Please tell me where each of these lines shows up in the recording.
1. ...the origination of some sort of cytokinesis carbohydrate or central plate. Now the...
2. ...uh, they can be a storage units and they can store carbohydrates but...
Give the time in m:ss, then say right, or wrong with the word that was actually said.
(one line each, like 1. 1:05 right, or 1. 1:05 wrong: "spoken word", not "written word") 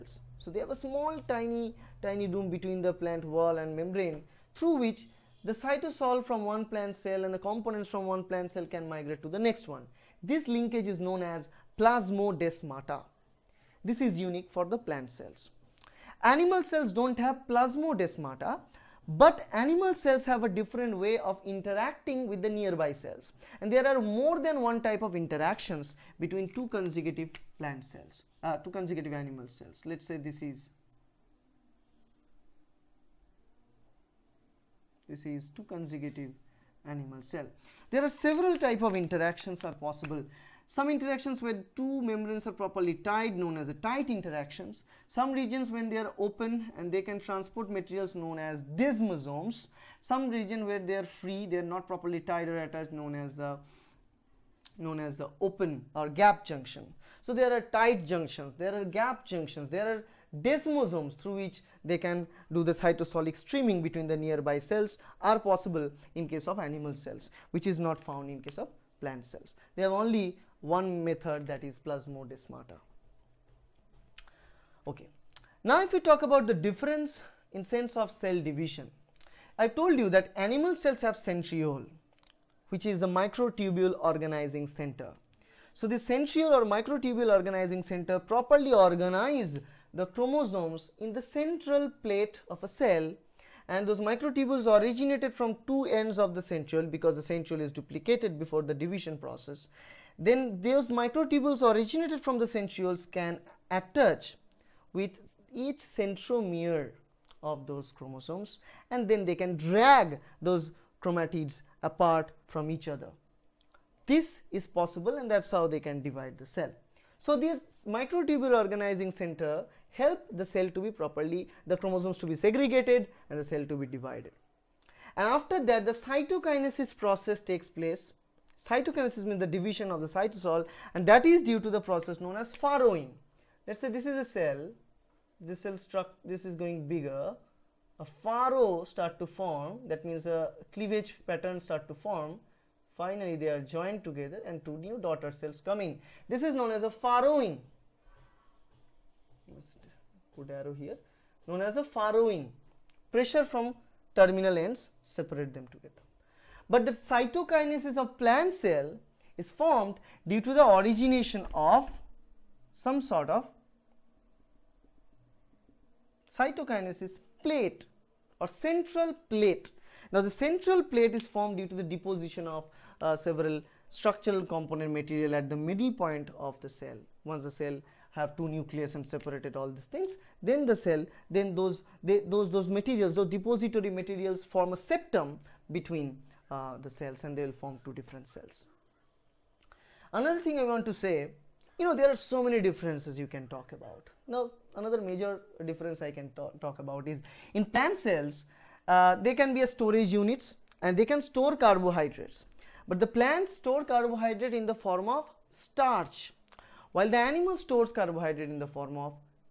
1. 2:40 wrong: "plate", not "carbohydrate"
2. 3:18 right.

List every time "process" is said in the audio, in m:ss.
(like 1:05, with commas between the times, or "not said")
1:39, 2:06, 2:11.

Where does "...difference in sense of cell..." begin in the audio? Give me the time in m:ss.
1:16.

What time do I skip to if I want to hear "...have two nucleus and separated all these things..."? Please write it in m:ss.
2:58.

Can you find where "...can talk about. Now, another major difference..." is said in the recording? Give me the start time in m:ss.
3:13.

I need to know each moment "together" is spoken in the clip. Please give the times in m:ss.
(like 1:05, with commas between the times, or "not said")
2:24, 2:35.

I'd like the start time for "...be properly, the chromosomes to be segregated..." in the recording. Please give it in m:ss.
2:00.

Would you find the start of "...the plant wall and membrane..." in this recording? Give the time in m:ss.
0:02.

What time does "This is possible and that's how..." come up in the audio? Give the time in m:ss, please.
1:54.